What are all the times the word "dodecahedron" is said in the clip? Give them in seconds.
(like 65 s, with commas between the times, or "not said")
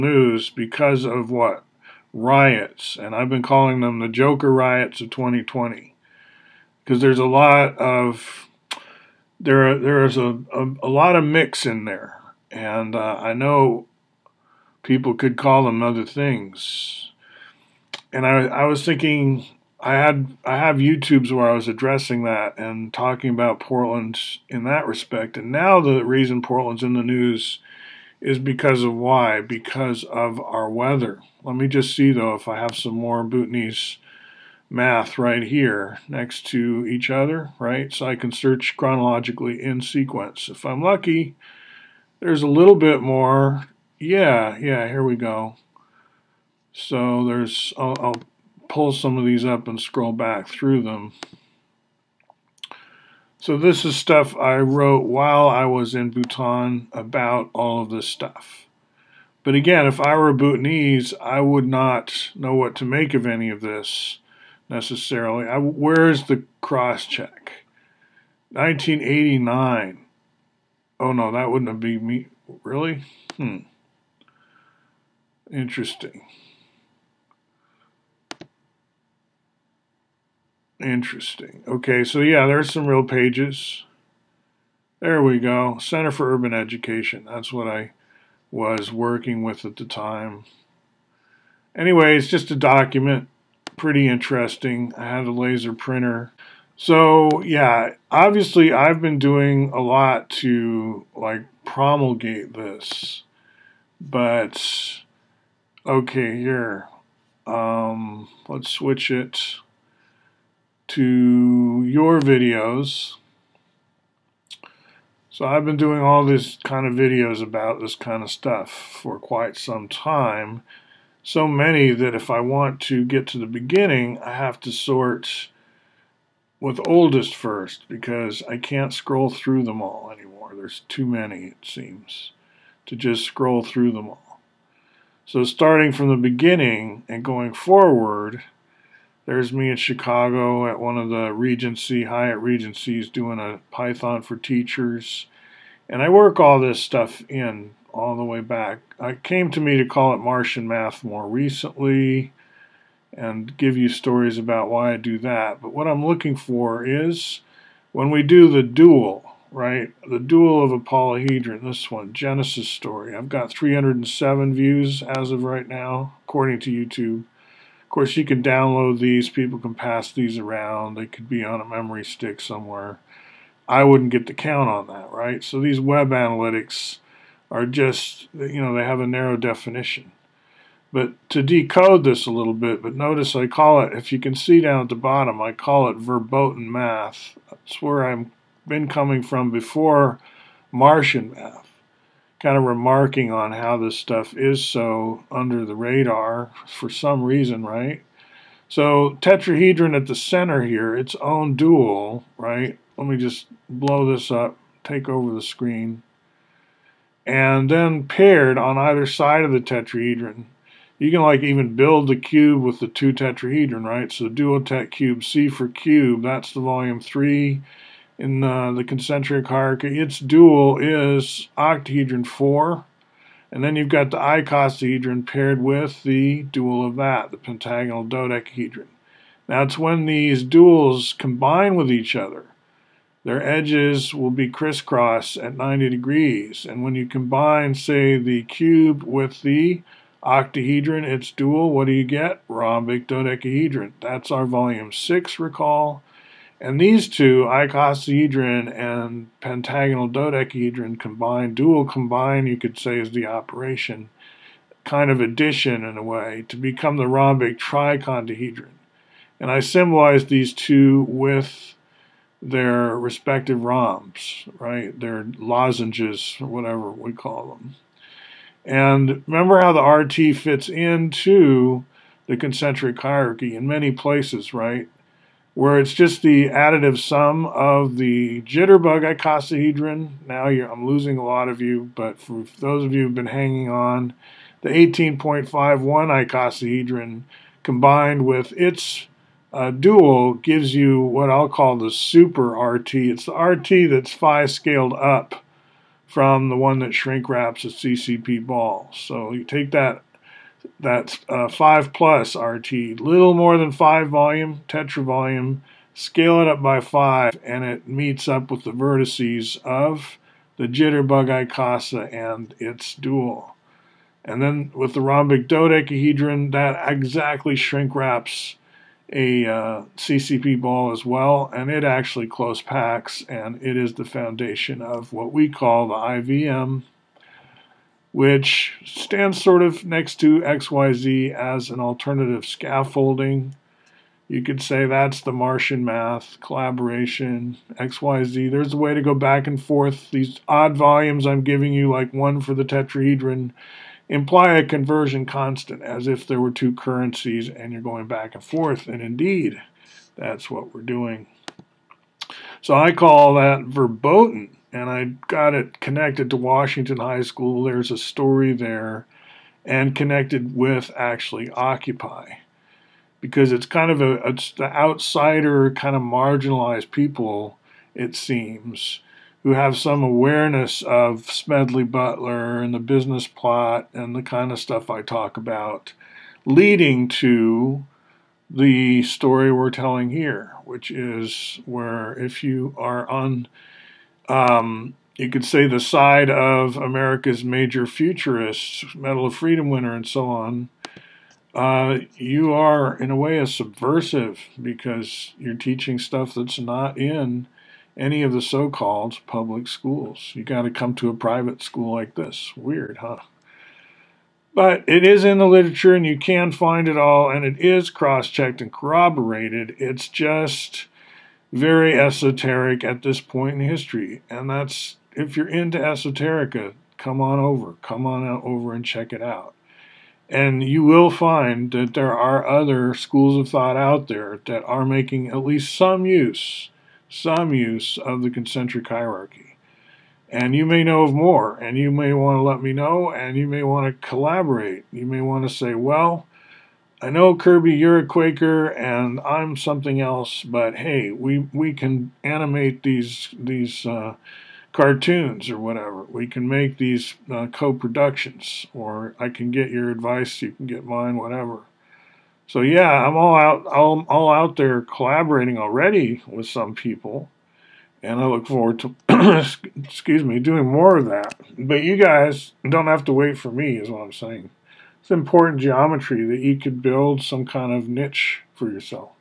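228 s, 243 s, 250 s, 315 s.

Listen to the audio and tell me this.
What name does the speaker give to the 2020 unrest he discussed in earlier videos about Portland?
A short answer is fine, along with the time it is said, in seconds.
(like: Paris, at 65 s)
Joker riots, at 4 s.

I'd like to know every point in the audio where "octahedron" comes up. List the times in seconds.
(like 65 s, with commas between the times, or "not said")
221 s, 240 s.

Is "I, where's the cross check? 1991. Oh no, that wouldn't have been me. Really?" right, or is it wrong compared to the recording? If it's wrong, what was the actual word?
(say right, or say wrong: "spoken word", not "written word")
wrong: "1989", not "1991".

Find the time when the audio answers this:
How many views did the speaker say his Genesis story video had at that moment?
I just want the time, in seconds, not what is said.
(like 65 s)
163 s.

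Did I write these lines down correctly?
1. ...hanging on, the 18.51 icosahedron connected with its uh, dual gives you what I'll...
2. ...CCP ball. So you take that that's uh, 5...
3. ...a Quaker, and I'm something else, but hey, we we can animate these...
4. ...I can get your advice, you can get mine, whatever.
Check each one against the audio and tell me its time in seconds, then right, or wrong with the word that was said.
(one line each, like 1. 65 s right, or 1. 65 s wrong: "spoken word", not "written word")
1. 283 s wrong: "combined", not "connected"
2. 297 s right
3. 437 s right
4. 449 s right.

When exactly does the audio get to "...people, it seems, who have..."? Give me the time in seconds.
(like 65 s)
366 s.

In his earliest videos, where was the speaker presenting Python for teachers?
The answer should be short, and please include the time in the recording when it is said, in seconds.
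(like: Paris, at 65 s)
Chicago, at 139 s.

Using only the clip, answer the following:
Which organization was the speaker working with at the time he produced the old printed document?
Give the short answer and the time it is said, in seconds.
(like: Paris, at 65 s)
Center for Urban Education, at 85 s.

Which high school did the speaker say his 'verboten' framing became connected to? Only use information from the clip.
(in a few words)
Washington High School.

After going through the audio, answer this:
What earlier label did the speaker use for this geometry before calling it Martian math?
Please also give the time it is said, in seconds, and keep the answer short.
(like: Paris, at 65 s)
verboten math, at 185 s.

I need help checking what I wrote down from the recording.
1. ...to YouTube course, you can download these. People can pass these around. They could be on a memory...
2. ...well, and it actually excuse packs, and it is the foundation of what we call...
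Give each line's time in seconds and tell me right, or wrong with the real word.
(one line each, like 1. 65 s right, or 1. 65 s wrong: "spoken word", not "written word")
1. 166 s right
2. 321 s wrong: "close", not "excuse".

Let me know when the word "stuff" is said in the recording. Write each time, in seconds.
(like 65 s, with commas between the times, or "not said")
53 s, 58 s, 118 s, 146 s, 193 s, 374 s, 395 s.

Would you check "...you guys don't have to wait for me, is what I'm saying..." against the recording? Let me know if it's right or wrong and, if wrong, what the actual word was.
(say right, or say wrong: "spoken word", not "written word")
right.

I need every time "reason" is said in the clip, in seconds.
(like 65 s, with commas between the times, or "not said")
26 s, 197 s.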